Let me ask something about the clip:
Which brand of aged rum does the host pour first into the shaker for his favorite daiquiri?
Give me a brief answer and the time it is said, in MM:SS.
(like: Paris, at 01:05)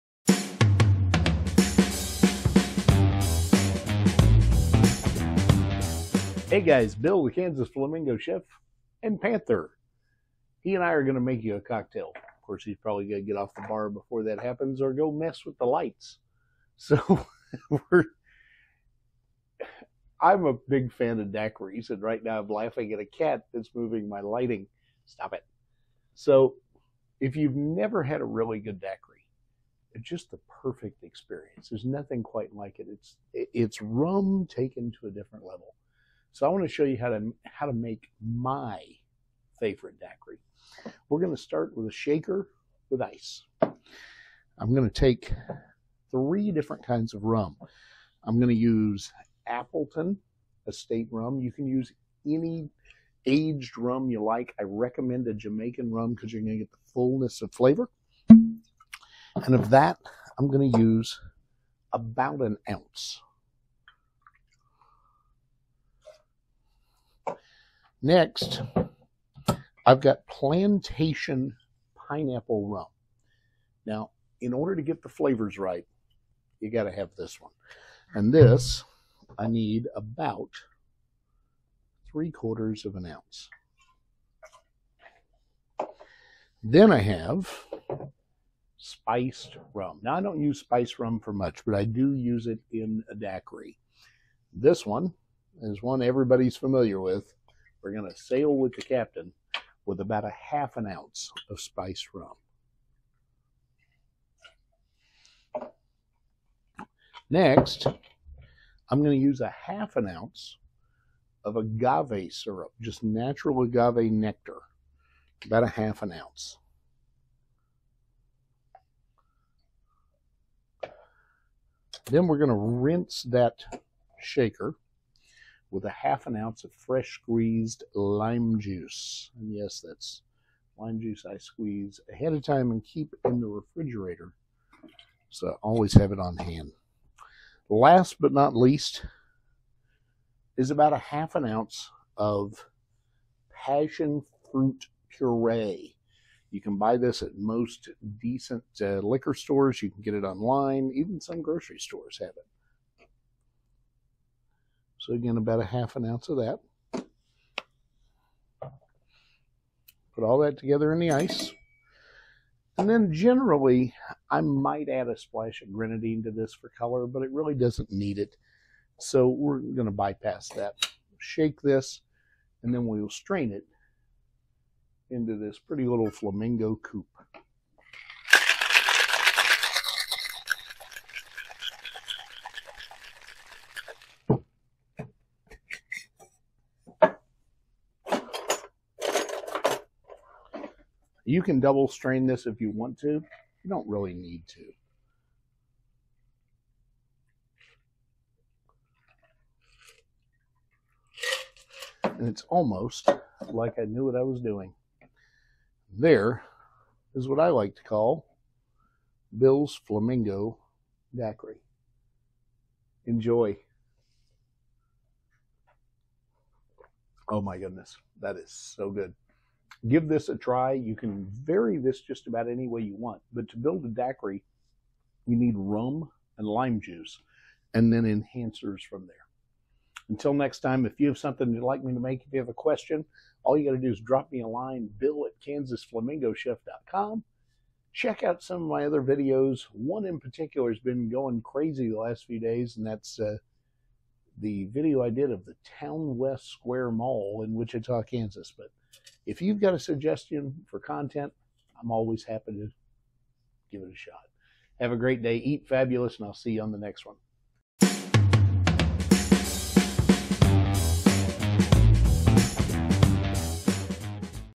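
Appleton Estate, at 00:49.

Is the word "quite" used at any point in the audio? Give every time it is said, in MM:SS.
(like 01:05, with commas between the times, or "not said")
00:32.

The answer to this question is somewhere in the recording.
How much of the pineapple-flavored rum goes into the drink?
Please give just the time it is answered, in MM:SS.
01:22.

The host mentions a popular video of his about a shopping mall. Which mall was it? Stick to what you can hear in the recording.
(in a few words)
Towne West Square.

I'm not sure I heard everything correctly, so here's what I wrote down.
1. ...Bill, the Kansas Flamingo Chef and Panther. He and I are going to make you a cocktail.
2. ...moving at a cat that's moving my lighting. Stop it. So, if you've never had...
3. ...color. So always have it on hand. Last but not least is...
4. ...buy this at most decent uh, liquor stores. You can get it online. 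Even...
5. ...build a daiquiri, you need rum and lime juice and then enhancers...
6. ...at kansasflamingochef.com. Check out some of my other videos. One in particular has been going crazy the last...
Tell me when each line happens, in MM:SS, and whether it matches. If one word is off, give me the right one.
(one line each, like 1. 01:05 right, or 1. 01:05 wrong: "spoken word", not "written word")
1. 00:06 right
2. 00:22 wrong: "laughing", not "moving"
3. 02:13 wrong: "refrigerator", not "color"
4. 02:26 right
5. 03:43 right
6. 03:55 right.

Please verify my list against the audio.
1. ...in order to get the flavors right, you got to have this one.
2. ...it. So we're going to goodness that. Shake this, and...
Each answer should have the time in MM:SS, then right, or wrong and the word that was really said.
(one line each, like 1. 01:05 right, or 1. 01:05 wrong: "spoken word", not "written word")
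1. 01:14 right
2. 02:48 wrong: "bypass", not "goodness".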